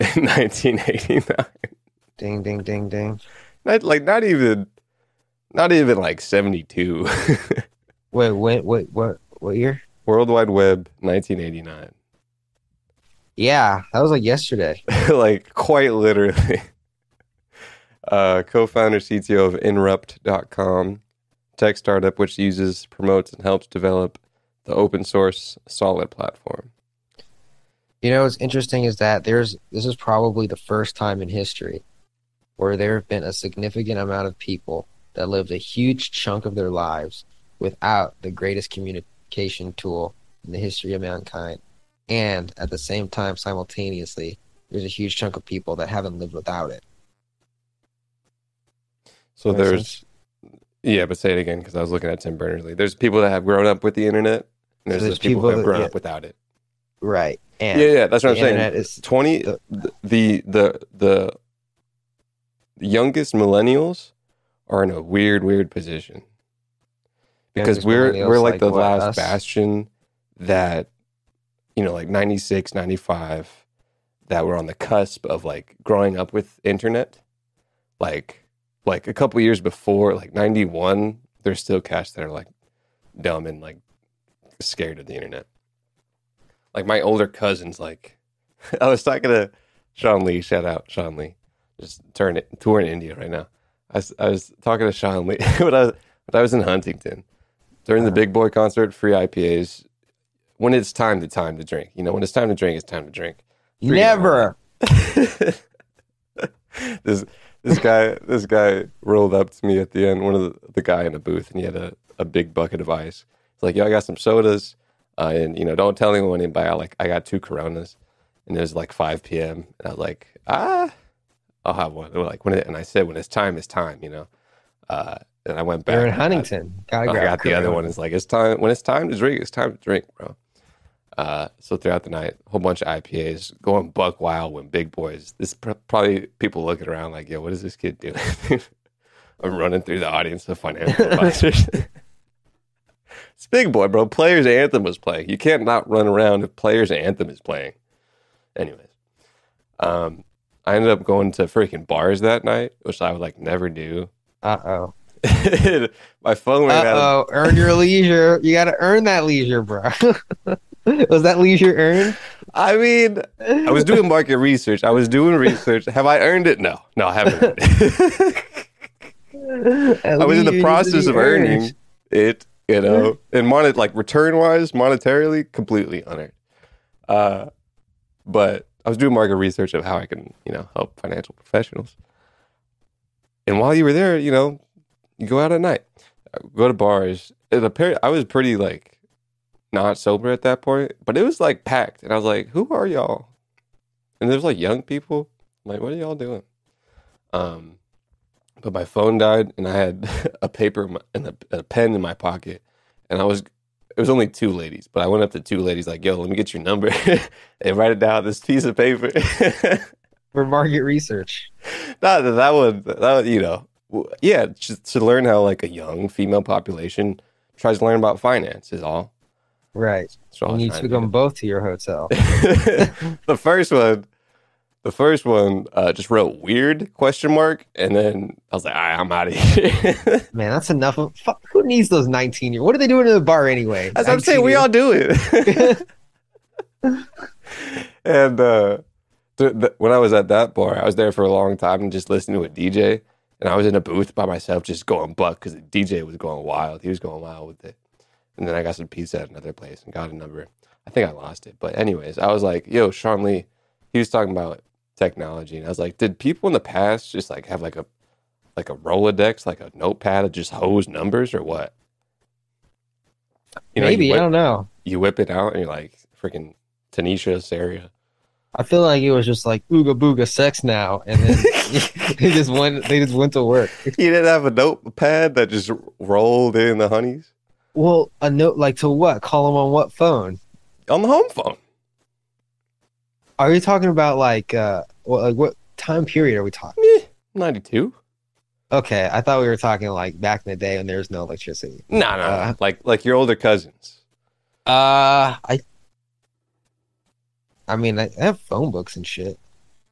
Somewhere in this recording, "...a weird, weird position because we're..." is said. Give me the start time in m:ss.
1:04.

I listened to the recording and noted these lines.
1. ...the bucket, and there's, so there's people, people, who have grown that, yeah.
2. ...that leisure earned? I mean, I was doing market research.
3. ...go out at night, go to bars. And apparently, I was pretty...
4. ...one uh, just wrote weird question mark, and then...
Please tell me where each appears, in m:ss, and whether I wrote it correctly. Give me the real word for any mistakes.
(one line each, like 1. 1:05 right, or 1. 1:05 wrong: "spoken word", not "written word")
1. 0:53 wrong: "internet", not "bucket"
2. 2:41 right
3. 3:05 right
4. 3:45 right.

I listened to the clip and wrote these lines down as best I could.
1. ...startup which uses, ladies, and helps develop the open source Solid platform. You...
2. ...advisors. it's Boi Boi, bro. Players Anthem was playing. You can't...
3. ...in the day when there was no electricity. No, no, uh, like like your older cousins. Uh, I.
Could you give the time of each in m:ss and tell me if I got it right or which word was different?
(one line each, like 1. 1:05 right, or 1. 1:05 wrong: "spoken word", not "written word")
1. 0:21 wrong: "promotes", not "ladies"
2. 2:21 wrong: "Big", not "Boi"
3. 4:50 right.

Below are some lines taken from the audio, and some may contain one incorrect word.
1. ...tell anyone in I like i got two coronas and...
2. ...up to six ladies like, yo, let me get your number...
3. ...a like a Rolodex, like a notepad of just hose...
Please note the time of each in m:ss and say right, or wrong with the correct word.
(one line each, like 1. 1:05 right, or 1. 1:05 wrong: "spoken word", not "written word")
1. 1:55 right
2. 3:25 wrong: "two", not "six"
3. 4:17 right.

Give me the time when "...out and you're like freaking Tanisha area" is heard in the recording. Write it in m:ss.
4:25.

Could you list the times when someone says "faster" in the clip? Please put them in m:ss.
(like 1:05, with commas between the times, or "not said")
not said.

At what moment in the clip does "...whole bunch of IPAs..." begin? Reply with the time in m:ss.
2:12.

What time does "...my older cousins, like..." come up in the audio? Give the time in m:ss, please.
1:26.